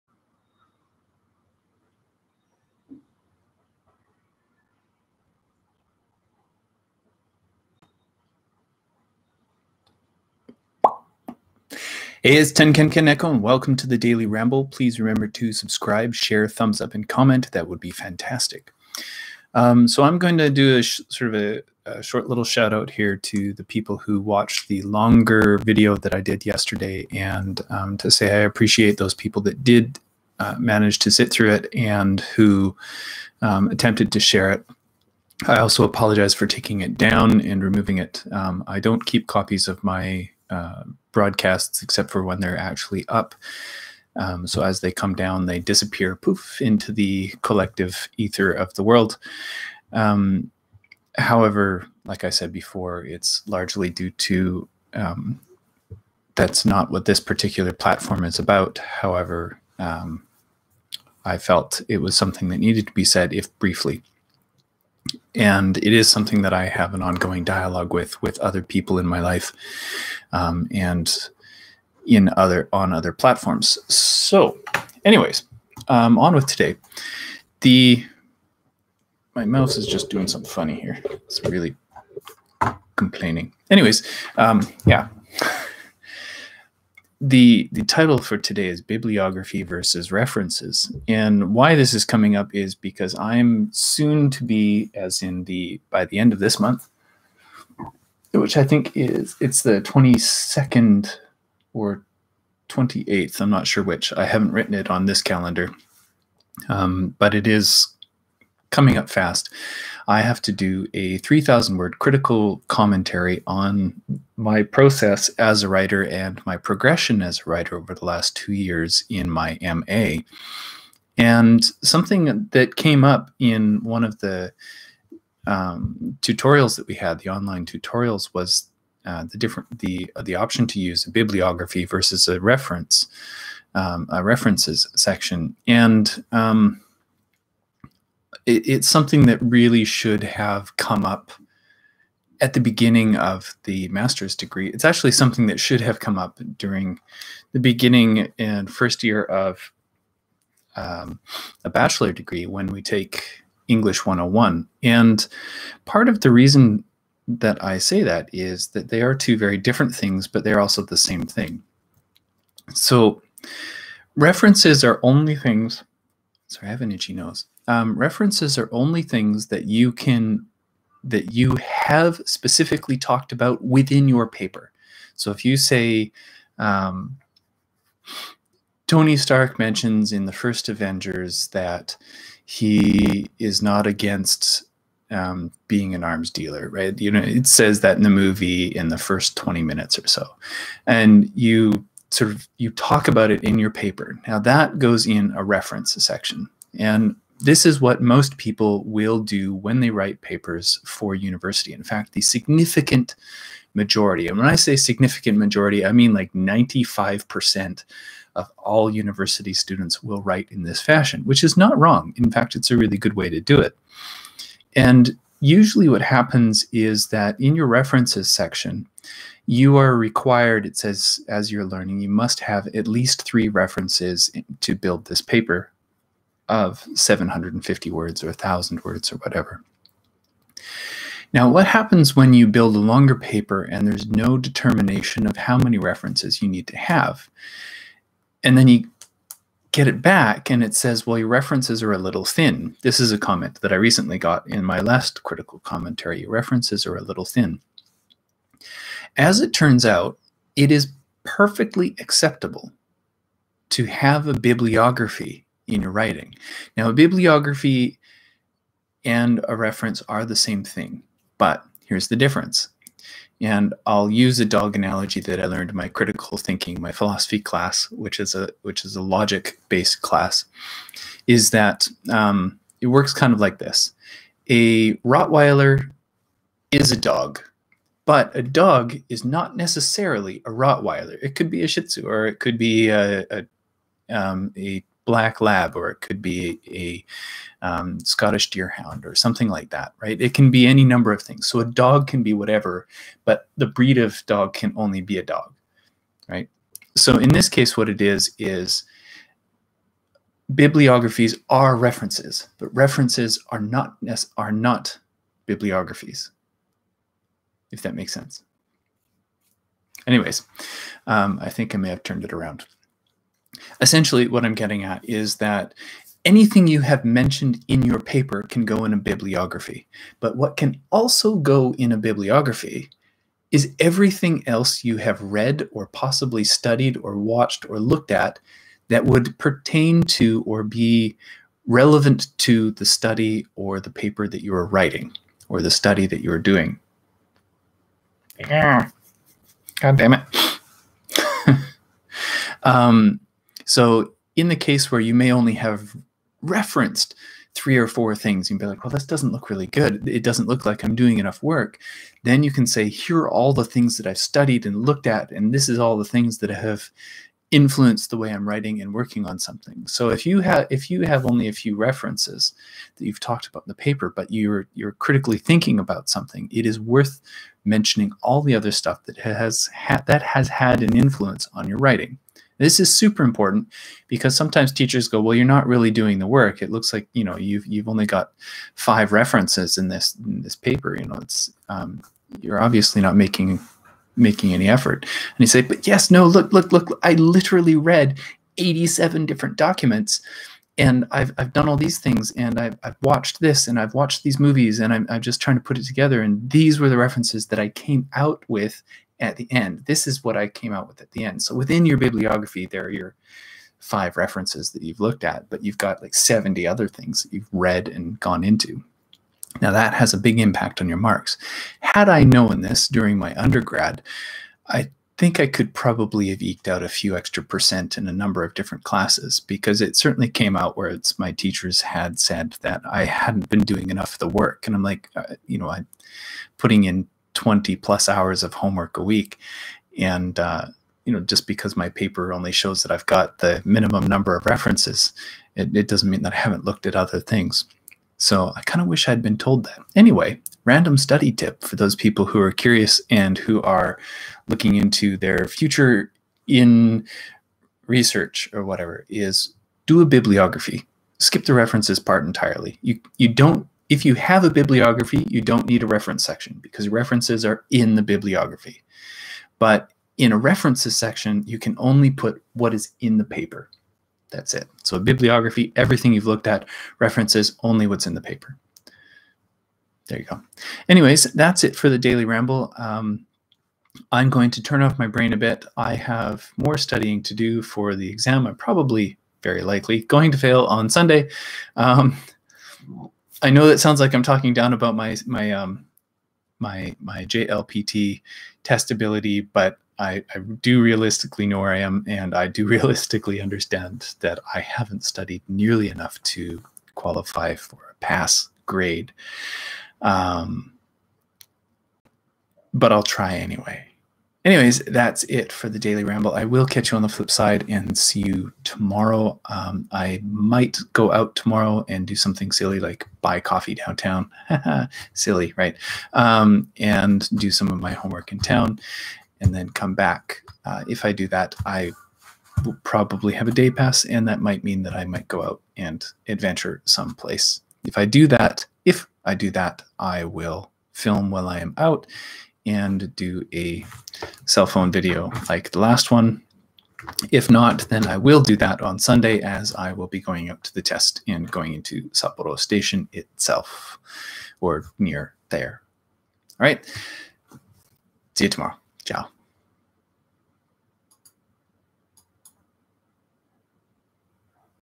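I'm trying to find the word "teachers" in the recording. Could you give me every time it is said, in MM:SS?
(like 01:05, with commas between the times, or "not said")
06:14, 07:01.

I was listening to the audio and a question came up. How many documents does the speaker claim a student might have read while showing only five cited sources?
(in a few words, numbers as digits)
87.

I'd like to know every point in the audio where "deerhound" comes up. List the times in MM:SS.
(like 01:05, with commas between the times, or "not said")
04:48.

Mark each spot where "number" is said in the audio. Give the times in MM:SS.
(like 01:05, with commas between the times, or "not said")
04:50, 06:58, 07:14.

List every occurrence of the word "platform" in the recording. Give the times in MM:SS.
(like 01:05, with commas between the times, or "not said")
00:57, 01:13.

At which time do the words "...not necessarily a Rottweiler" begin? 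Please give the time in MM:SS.
04:39.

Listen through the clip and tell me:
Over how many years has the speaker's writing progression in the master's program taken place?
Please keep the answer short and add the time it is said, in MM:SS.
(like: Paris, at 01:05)
two years, at 01:58.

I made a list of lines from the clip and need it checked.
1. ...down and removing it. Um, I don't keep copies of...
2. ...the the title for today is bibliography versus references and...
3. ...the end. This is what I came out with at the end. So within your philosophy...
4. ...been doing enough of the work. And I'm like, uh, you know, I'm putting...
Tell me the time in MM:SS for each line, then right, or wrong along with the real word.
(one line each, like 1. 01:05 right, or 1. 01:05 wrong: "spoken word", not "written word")
1. 00:36 right
2. 01:27 right
3. 06:39 wrong: "bibliography", not "philosophy"
4. 07:03 right.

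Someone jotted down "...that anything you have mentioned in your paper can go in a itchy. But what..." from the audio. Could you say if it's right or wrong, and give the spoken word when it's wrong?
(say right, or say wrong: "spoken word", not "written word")
wrong: "bibliography", not "itchy".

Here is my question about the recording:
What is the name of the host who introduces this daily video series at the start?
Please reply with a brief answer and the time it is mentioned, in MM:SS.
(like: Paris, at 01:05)
Tankenka Neko, at 00:12.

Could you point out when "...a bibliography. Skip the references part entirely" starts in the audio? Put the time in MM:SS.
07:30.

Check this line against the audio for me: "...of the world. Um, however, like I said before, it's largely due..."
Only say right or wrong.
right.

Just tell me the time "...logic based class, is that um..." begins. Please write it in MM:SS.
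04:29.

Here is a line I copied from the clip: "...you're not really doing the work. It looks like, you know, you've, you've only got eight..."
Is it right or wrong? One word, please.
wrong.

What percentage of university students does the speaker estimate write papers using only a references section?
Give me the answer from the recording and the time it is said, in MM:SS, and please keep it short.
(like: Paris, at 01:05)
95%, at 03:26.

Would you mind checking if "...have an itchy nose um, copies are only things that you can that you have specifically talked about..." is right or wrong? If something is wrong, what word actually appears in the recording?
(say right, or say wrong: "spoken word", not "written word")
wrong: "references", not "copies".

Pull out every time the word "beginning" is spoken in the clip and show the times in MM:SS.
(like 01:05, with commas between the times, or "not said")
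02:22, 02:27.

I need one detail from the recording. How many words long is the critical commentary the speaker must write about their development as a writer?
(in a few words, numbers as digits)
3,000.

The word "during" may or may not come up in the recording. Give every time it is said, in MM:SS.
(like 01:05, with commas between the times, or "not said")
02:26, 06:52.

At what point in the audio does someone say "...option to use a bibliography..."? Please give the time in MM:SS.
02:10.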